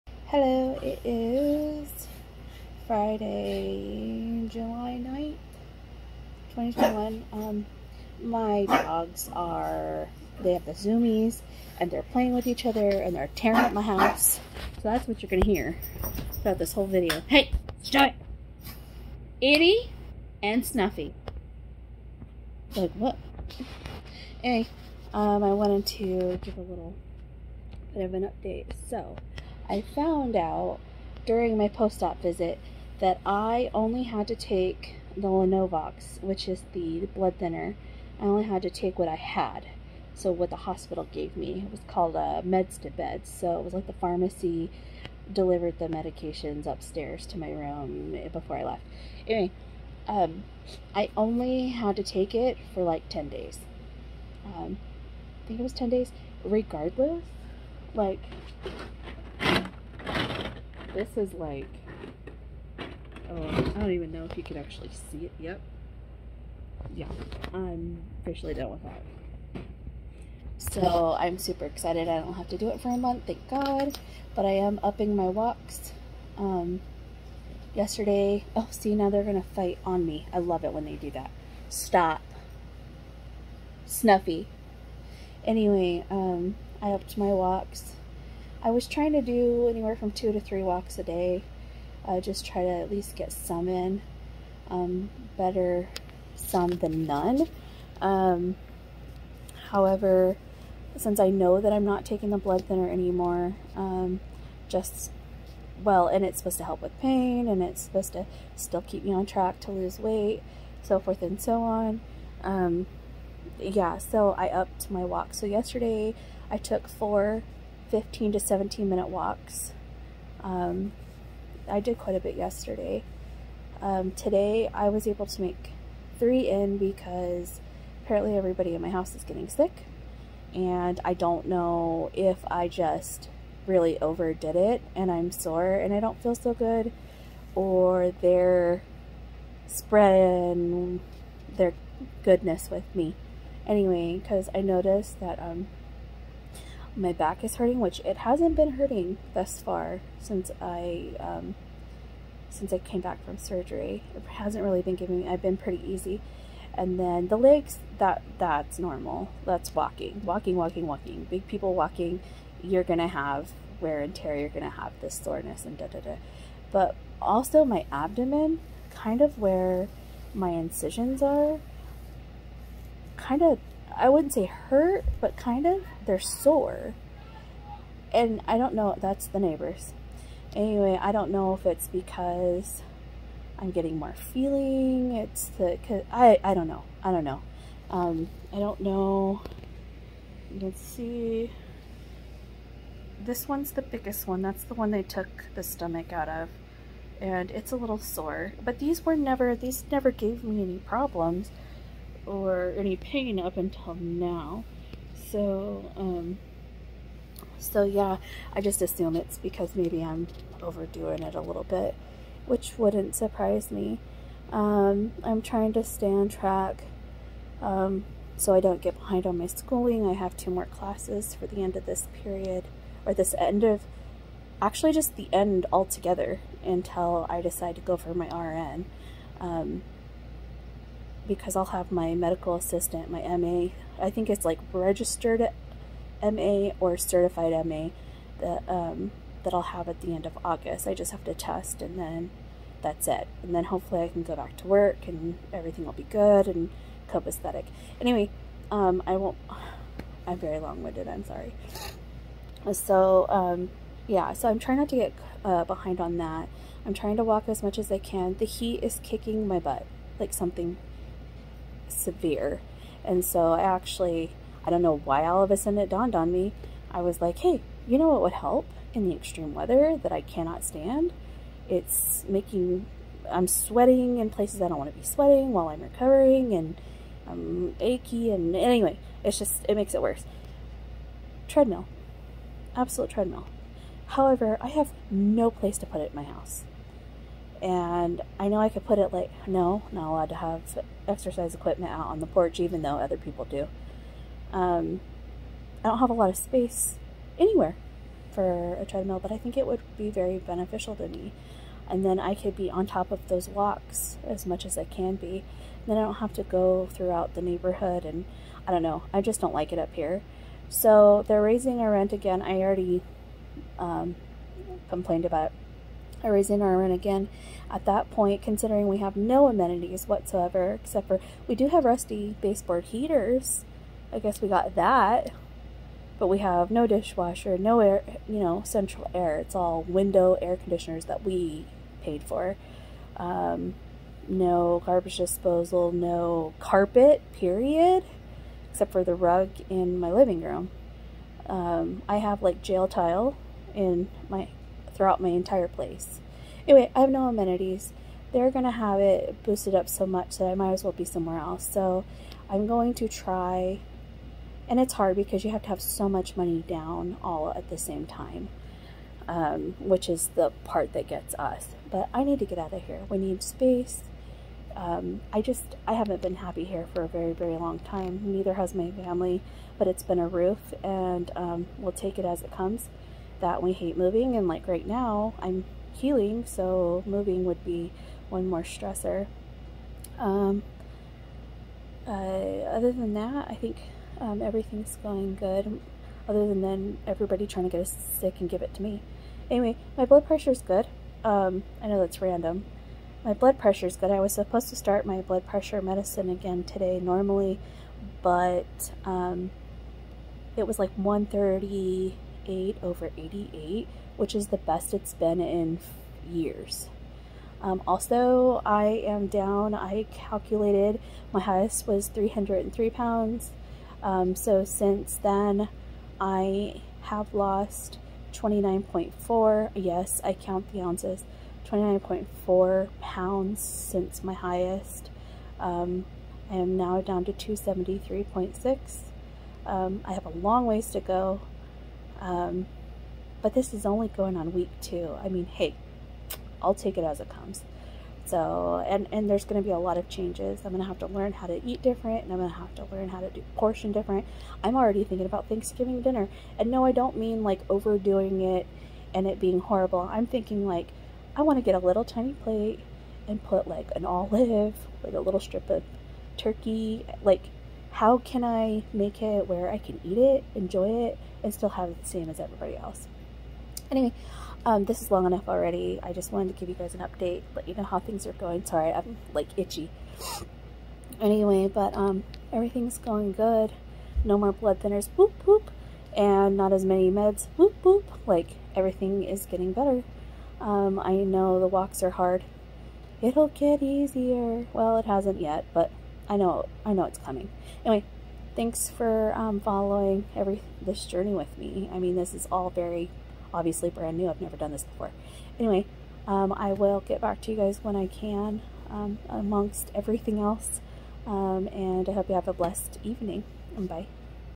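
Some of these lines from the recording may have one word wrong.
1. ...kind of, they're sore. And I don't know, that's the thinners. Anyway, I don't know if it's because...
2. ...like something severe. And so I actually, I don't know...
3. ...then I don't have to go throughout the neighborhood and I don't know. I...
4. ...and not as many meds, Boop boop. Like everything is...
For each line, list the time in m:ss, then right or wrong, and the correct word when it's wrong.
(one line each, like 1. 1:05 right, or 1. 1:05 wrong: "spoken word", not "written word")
1. 2:55 wrong: "neighbors", not "thinners"
2. 4:20 right
3. 5:05 right
4. 7:56 right.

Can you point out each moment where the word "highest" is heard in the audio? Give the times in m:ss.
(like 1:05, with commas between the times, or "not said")
6:51, 7:04.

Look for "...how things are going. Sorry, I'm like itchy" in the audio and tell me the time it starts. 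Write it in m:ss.
7:47.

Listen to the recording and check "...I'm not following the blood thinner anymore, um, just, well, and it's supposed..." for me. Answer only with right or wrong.
wrong.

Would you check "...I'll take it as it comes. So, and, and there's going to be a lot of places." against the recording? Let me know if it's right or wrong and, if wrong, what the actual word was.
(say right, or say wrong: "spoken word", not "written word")
wrong: "changes", not "places".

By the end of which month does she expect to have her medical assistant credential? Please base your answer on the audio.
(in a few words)
August.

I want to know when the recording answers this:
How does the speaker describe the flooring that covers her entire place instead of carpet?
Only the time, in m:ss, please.
5:42.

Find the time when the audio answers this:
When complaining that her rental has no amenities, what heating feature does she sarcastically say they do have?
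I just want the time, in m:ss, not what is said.
5:21.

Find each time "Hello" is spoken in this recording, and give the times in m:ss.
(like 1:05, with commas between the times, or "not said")
0:00.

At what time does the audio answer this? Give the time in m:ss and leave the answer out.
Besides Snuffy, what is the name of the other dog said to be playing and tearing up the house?
0:19.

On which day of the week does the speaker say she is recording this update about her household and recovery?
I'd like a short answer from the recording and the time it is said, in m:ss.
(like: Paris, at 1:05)
Friday, at 0:02.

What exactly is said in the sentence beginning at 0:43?
So it was like the pharmacy delivered the medications upstairs to my room before I left.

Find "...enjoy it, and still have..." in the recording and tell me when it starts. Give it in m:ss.
7:40.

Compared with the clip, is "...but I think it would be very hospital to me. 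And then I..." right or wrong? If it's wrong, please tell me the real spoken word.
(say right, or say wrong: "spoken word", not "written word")
wrong: "beneficial", not "hospital".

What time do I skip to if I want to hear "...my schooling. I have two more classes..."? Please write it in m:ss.
3:39.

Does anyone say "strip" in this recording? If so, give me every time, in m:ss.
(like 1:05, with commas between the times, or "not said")
7:35.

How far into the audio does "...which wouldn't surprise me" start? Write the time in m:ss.
3:32.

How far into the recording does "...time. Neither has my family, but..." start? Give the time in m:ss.
6:07.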